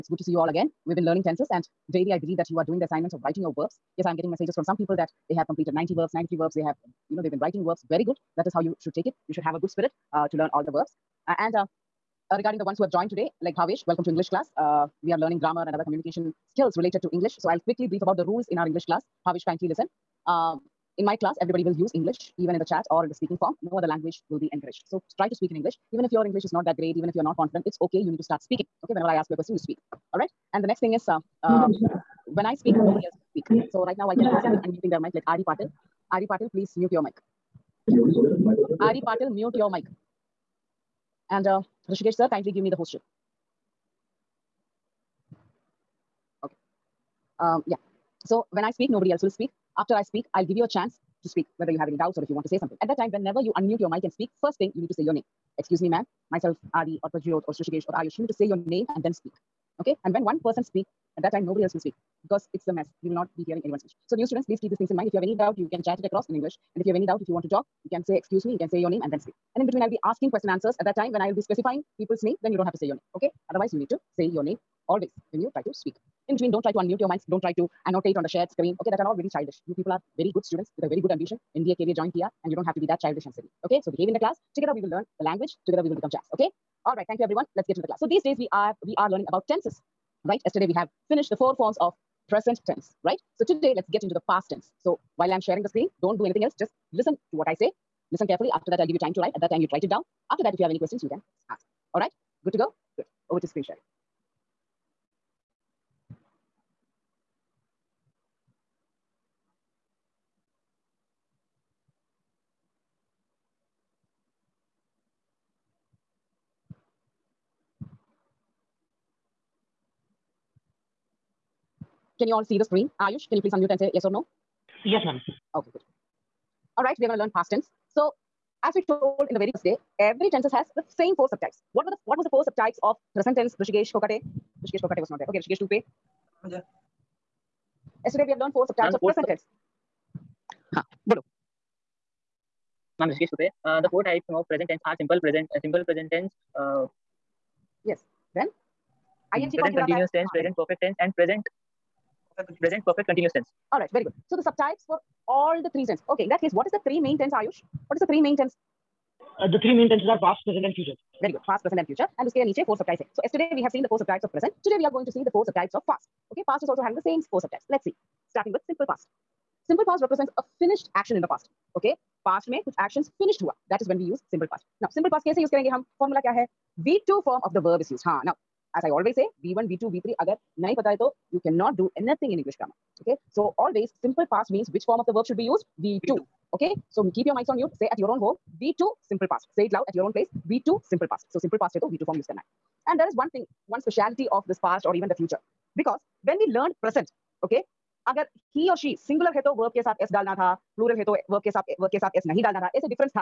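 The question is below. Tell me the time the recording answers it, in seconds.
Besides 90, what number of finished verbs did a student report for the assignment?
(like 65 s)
6 s.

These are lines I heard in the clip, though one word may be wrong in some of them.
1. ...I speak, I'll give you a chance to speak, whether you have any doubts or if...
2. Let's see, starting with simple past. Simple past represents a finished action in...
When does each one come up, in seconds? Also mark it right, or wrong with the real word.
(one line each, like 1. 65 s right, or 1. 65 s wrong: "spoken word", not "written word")
1. 49 s right
2. 167 s right.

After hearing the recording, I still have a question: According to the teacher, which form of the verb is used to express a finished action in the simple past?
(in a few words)
V2.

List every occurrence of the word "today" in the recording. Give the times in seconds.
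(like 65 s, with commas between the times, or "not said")
13 s, 93 s, 164 s.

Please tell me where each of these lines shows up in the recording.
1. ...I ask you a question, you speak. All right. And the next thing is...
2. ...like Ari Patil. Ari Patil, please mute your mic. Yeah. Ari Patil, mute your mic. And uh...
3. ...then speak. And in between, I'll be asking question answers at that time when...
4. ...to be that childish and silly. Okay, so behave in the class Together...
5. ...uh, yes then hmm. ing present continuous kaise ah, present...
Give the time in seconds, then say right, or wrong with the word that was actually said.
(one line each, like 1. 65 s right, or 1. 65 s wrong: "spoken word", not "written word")
1. 29 s right
2. 35 s right
3. 69 s right
4. 82 s right
5. 146 s wrong: "tense", not "kaise".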